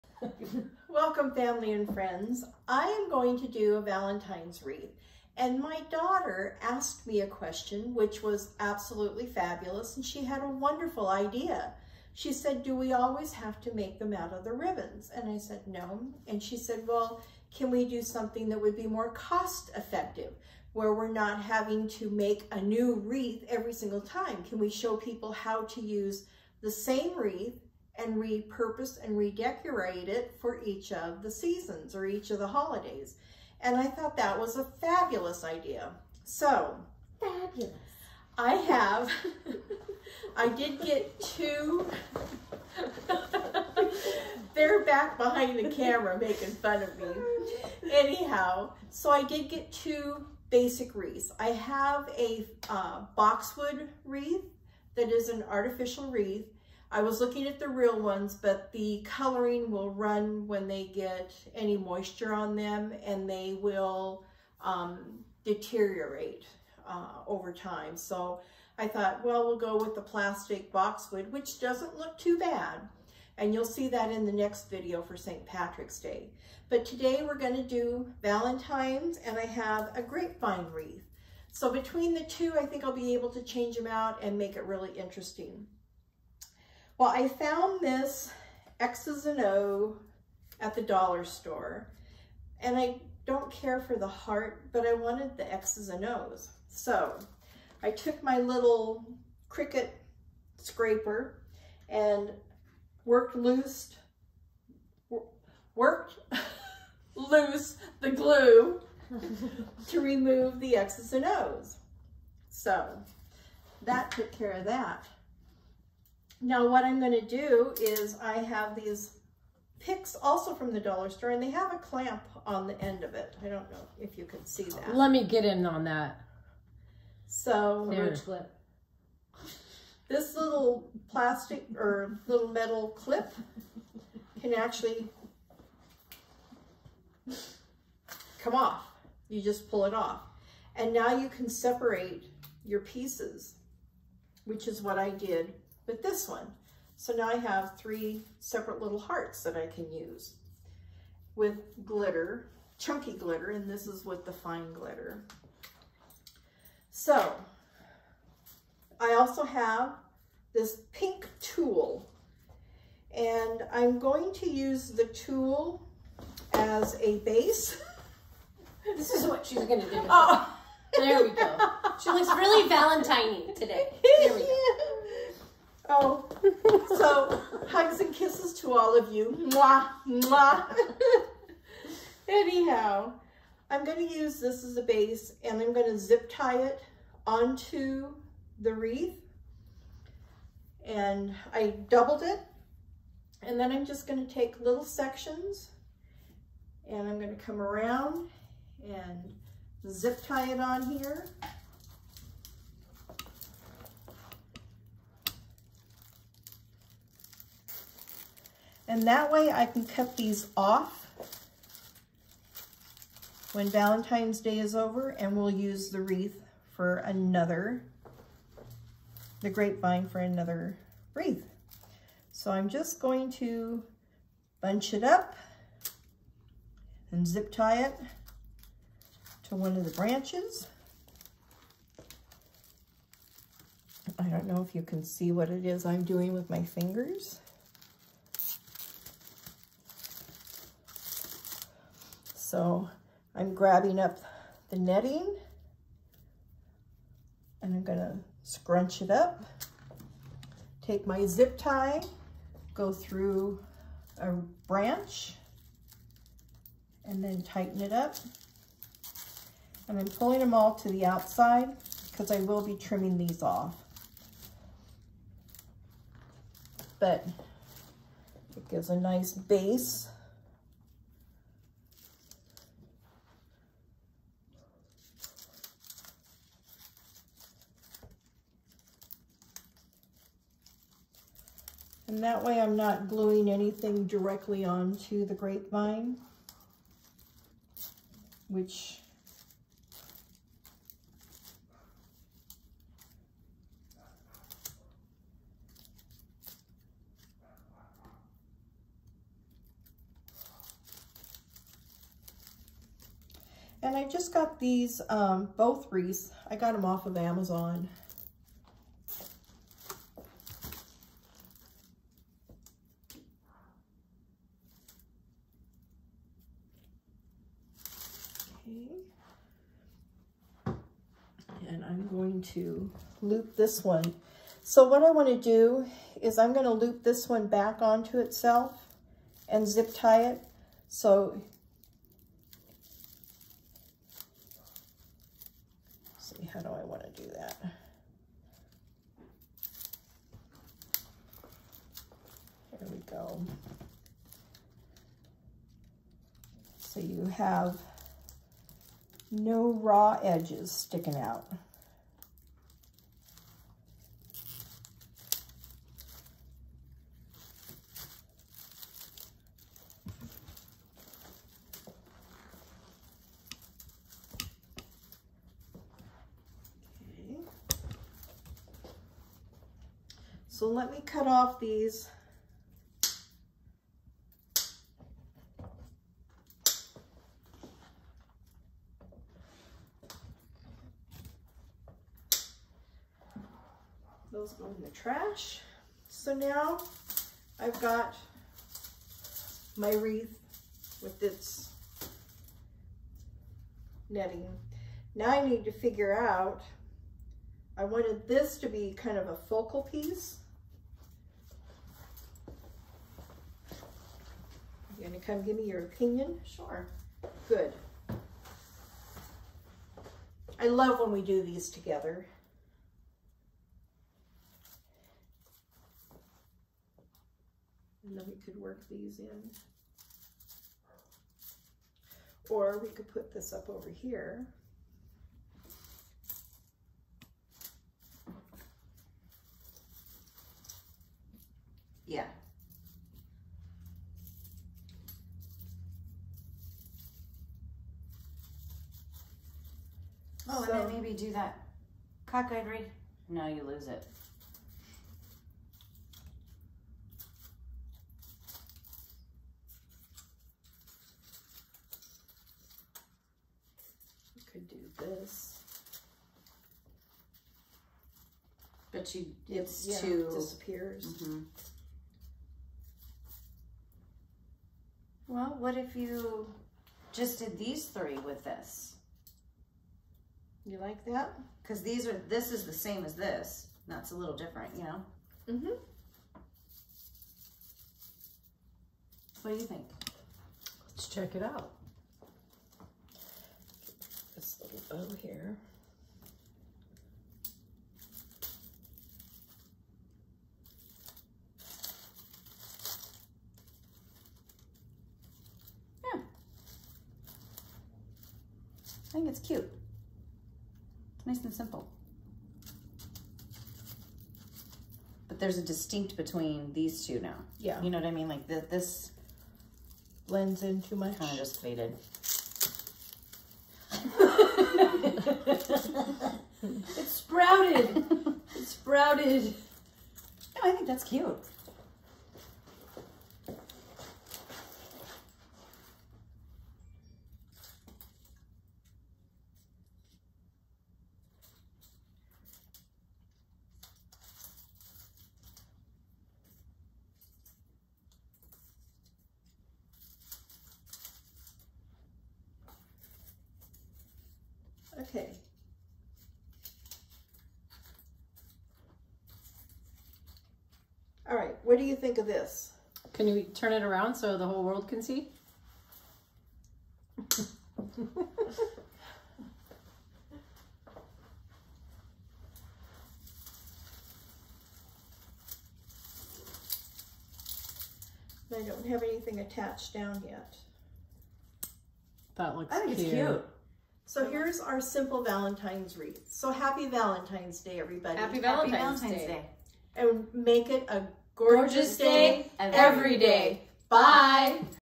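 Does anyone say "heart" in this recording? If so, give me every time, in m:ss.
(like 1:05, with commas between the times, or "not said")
1:34, 2:28.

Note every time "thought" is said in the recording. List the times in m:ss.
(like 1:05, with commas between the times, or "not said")
0:33, 1:08.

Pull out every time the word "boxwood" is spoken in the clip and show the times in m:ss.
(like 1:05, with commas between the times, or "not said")
0:53, 1:10.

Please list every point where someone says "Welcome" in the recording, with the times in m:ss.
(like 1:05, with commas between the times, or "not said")
0:00.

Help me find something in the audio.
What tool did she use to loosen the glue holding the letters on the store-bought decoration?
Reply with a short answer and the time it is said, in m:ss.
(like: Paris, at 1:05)
Cricut scraper, at 1:39.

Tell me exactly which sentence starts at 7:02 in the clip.
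Or we could put this up over here.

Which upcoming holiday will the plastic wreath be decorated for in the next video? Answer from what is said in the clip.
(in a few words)
St. Patrick's Day.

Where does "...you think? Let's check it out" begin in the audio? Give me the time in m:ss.
7:59.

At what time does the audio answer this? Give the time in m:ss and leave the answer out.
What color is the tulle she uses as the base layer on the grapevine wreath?
2:40.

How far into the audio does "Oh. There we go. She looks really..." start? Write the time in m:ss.
2:50.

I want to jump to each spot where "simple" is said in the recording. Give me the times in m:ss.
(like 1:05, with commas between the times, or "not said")
8:21, 9:34.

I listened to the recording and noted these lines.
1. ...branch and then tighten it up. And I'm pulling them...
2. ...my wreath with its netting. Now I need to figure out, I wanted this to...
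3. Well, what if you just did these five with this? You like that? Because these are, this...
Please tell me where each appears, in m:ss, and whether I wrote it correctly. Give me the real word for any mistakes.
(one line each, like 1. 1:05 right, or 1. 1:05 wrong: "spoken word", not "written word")
1. 4:14 right
2. 6:29 right
3. 7:45 wrong: "three", not "five".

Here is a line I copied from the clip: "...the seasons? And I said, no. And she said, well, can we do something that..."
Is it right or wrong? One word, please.
wrong.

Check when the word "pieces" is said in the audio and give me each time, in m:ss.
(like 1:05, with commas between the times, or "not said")
2:22, 6:39.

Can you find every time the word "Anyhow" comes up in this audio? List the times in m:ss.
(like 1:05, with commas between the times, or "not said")
0:47, 3:02.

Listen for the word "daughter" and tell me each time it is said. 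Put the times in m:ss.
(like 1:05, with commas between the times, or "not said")
0:05.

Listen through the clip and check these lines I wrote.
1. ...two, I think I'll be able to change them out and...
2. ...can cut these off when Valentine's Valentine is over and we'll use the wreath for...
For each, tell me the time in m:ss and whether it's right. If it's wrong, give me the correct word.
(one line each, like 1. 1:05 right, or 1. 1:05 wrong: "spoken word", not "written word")
1. 1:22 right
2. 3:29 wrong: "Day", not "Valentine".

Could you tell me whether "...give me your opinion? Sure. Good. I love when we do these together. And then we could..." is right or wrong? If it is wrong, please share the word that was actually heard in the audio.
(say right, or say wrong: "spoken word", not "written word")
right.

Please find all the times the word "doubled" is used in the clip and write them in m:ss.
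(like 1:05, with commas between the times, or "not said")
3:11.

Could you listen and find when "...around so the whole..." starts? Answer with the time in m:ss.
9:13.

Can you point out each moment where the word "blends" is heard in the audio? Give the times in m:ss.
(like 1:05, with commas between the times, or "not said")
8:30.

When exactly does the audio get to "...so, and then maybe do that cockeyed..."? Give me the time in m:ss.
7:20.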